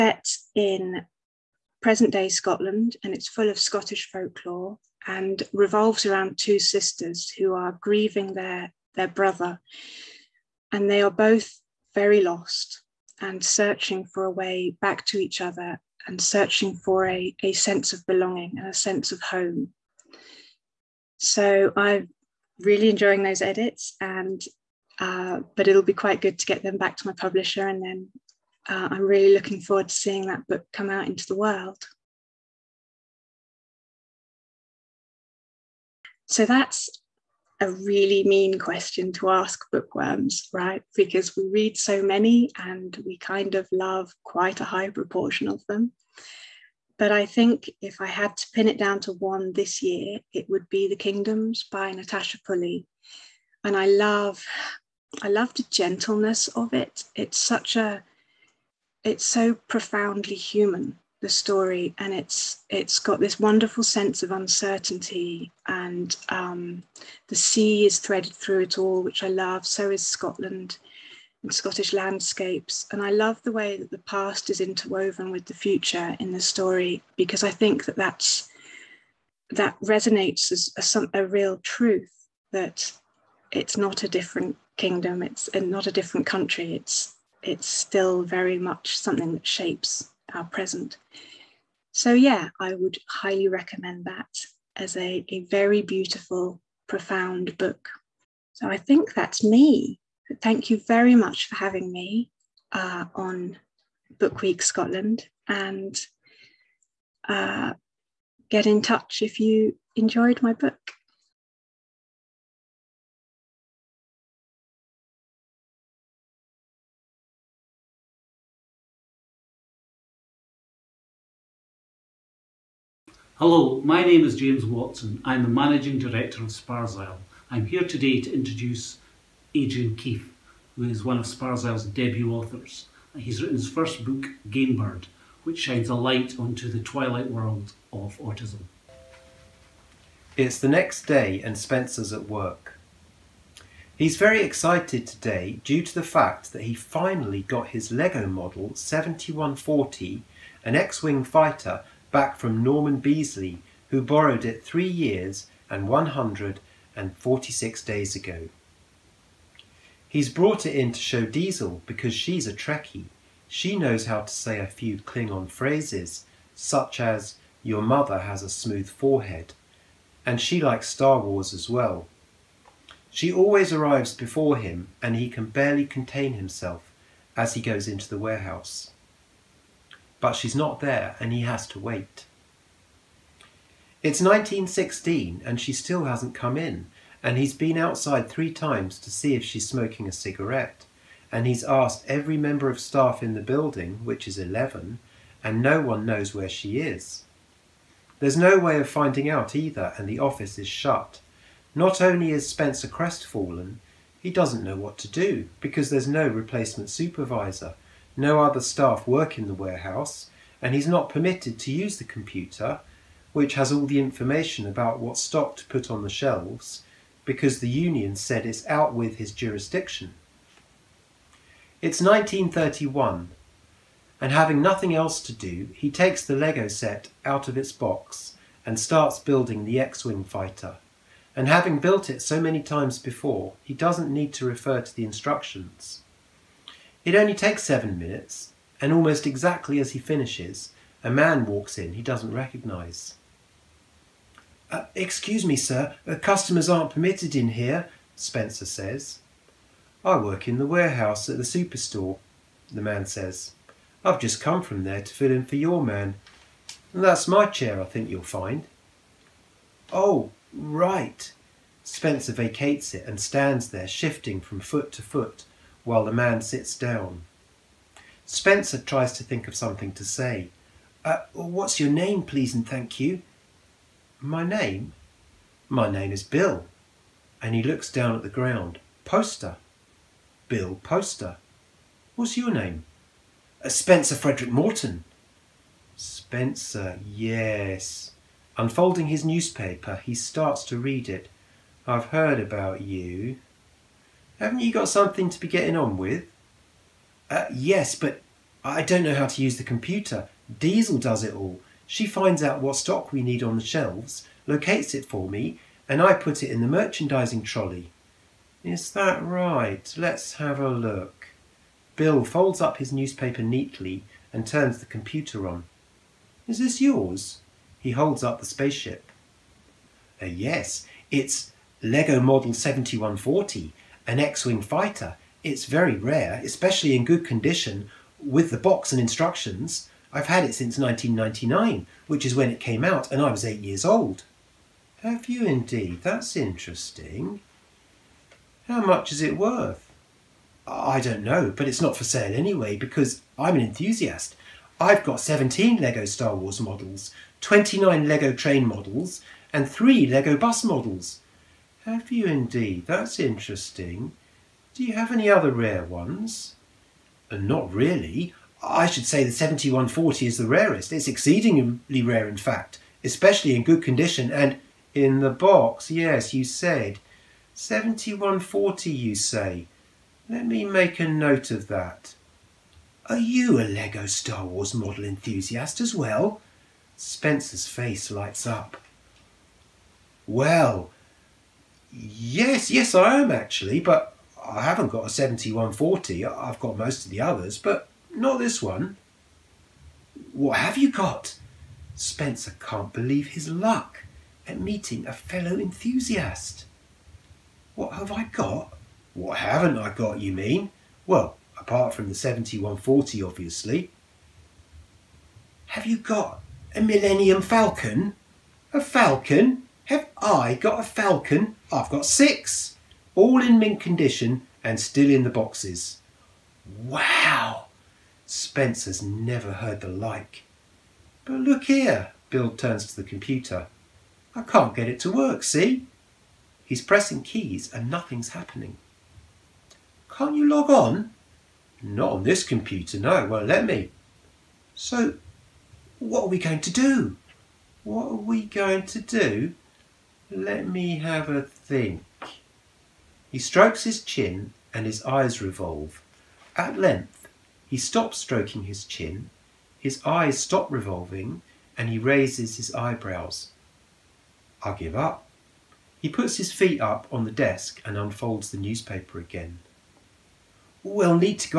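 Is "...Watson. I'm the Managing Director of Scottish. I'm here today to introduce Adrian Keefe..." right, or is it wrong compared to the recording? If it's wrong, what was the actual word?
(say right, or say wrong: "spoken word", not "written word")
wrong: "Sparsile", not "Scottish".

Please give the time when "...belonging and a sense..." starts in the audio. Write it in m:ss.
0:18.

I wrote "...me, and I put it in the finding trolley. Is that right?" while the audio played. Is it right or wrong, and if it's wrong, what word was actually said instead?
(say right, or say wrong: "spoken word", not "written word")
wrong: "merchandising", not "finding".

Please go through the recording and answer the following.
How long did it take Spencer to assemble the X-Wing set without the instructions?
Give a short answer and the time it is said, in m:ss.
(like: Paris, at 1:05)
7 minutes, at 3:57.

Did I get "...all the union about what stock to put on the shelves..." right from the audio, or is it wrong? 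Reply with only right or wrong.
wrong.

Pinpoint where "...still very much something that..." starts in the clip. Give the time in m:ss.
1:27.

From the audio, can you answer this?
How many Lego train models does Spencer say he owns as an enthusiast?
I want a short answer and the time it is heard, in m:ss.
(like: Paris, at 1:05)
29, at 5:47.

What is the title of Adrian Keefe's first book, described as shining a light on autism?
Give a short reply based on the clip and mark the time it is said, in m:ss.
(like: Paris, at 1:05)
Gamebird, at 2:14.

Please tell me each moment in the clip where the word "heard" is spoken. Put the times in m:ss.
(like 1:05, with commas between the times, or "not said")
4:52, 6:59.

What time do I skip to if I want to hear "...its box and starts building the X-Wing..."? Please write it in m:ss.
3:47.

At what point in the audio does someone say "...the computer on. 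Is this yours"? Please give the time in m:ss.
5:14.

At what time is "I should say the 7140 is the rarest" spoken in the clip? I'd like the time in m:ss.
5:58.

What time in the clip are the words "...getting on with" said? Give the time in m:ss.
4:55.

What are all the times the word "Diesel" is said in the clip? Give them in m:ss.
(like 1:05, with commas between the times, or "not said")
2:41, 5:00.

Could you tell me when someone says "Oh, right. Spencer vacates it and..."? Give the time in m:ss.
4:19.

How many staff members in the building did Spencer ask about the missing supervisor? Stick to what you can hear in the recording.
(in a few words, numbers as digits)
11.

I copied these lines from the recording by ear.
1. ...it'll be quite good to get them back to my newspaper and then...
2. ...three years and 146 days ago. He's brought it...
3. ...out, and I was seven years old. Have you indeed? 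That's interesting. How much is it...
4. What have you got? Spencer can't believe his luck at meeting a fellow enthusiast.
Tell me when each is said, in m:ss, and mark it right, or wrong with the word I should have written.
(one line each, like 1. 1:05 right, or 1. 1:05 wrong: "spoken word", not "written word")
1. 0:25 wrong: "publisher", not "newspaper"
2. 2:34 right
3. 5:32 wrong: "eight", not "seven"
4. 6:30 right.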